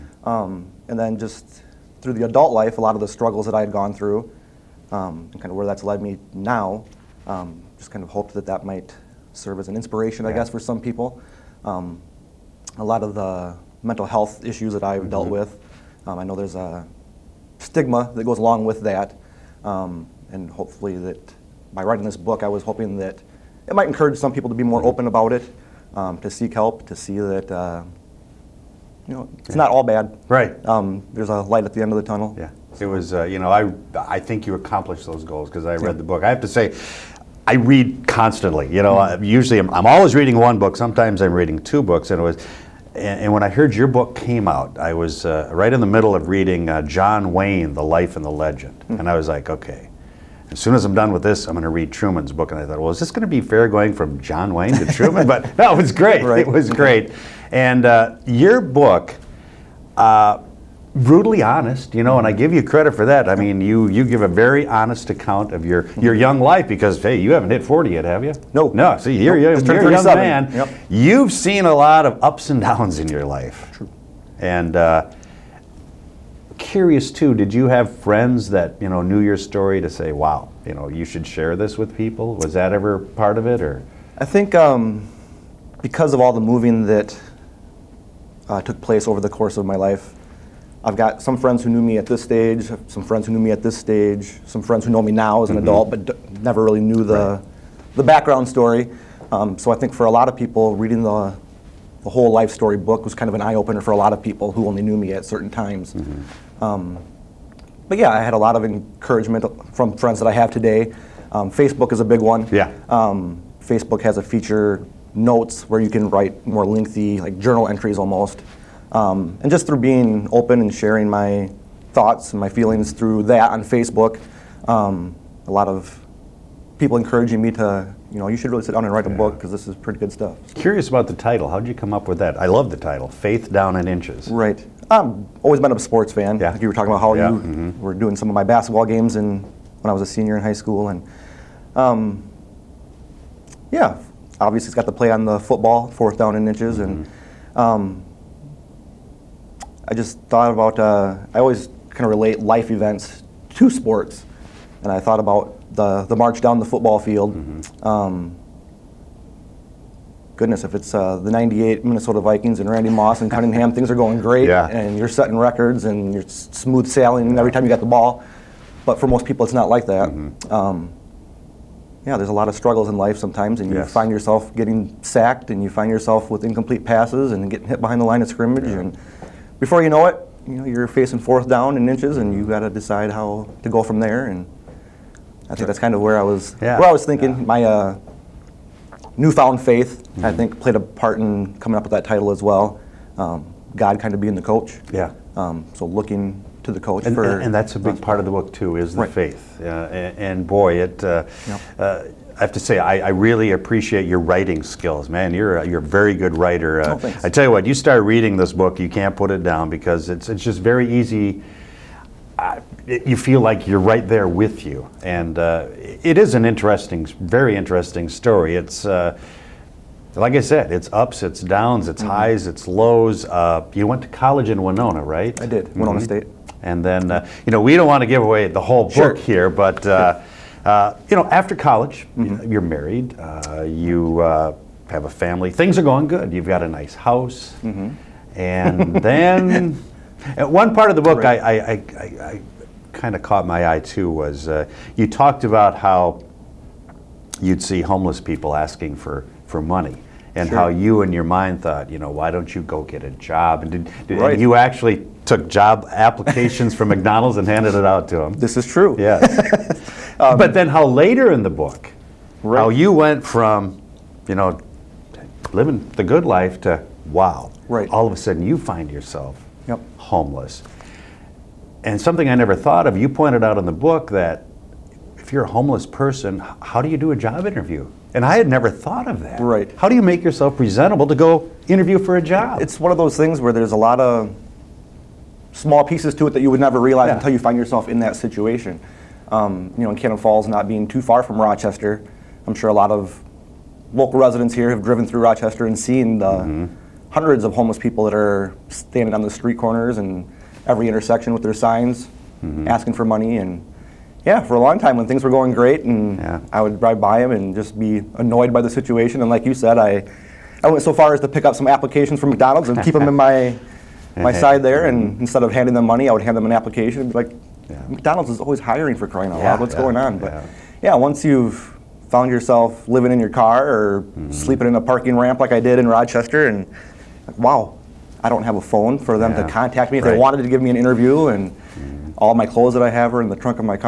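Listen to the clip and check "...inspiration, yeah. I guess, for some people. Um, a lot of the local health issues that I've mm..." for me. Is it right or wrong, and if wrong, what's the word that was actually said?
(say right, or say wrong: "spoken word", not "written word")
wrong: "mental", not "local".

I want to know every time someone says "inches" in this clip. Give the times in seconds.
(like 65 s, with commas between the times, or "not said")
133 s, 146 s, 181 s.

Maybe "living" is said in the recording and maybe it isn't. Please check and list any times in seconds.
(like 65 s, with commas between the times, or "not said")
265 s, 322 s.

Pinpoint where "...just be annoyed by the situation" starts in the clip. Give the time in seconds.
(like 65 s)
307 s.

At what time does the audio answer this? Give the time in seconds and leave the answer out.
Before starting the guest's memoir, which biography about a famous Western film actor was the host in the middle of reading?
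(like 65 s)
46 s.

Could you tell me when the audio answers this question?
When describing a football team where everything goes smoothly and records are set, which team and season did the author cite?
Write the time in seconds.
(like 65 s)
161 s.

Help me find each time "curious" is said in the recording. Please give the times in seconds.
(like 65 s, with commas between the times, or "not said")
76 s, 130 s.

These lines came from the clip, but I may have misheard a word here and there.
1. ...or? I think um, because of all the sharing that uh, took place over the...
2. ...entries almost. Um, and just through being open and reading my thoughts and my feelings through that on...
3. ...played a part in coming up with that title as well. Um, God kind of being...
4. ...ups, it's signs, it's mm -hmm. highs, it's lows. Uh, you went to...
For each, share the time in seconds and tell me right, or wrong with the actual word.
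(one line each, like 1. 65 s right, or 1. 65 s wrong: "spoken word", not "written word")
1. 83 s wrong: "moving", not "sharing"
2. 117 s wrong: "sharing", not "reading"
3. 190 s right
4. 220 s wrong: "downs", not "signs".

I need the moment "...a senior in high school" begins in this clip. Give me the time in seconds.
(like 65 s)
140 s.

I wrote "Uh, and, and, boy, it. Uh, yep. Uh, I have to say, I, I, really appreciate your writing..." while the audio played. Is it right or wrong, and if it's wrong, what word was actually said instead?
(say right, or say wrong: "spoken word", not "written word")
right.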